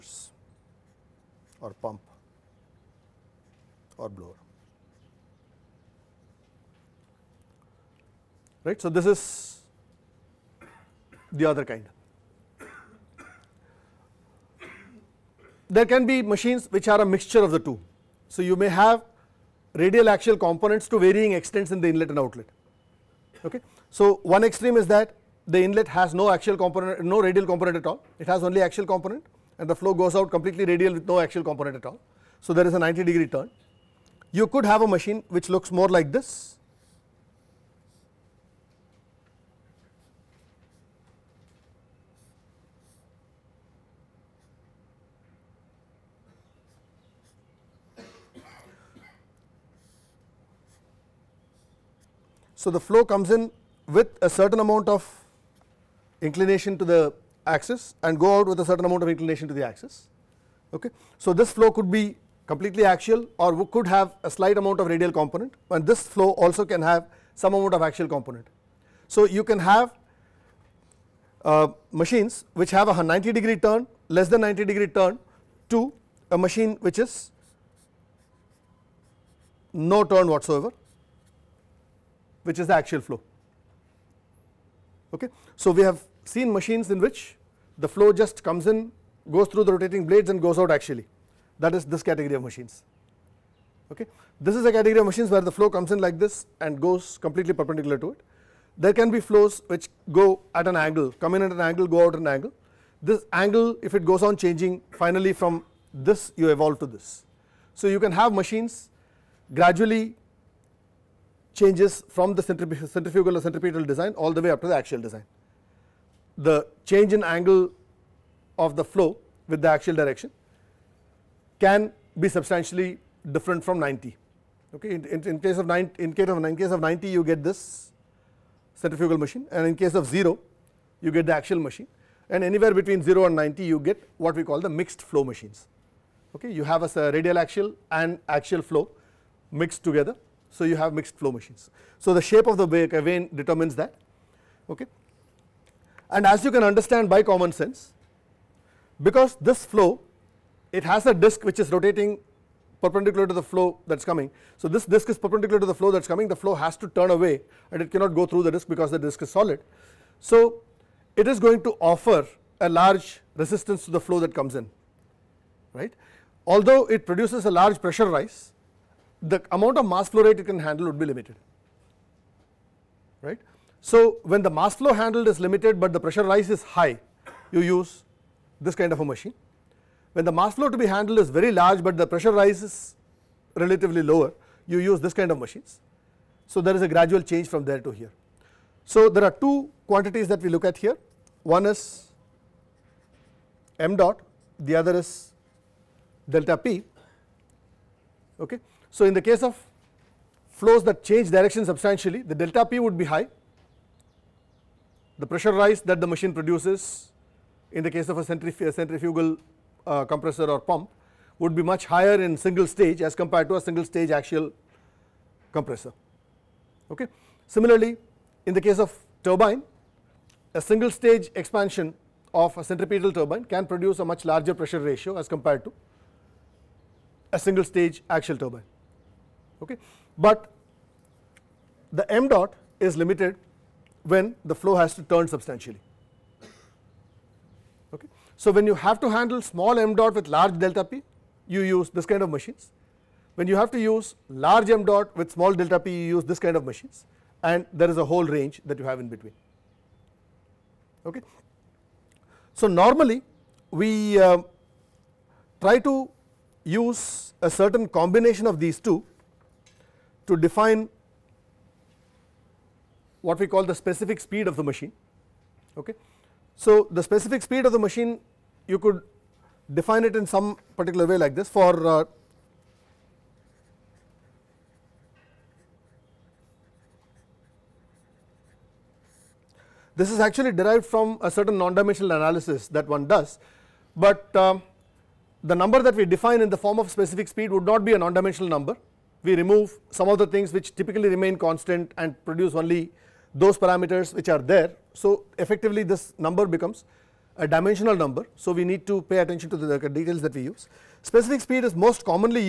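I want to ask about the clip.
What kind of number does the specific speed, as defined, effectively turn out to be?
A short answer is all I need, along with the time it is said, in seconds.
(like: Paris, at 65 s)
dimensional number, at 297 s.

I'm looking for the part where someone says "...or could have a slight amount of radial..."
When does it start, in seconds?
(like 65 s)
63 s.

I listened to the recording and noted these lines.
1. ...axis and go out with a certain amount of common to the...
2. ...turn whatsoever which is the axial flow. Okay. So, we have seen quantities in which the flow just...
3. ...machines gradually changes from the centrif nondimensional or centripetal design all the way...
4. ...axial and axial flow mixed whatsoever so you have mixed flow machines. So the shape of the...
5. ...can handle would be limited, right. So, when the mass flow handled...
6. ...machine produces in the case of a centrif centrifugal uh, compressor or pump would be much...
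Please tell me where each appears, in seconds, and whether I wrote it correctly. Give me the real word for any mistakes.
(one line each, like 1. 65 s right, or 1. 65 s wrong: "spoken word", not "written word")
1. 57 s wrong: "inclination", not "common"
2. 80 s wrong: "machines", not "quantities"
3. 108 s wrong: "centrifugal", not "nondimensional"
4. 137 s wrong: "together", not "whatsoever"
5. 170 s right
6. 206 s right.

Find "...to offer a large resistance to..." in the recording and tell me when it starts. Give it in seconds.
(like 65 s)
161 s.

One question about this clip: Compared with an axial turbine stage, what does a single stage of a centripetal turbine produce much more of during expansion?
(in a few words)
pressure ratio.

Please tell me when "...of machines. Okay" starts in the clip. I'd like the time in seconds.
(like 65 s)
92 s.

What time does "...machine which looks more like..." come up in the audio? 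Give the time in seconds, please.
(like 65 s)
34 s.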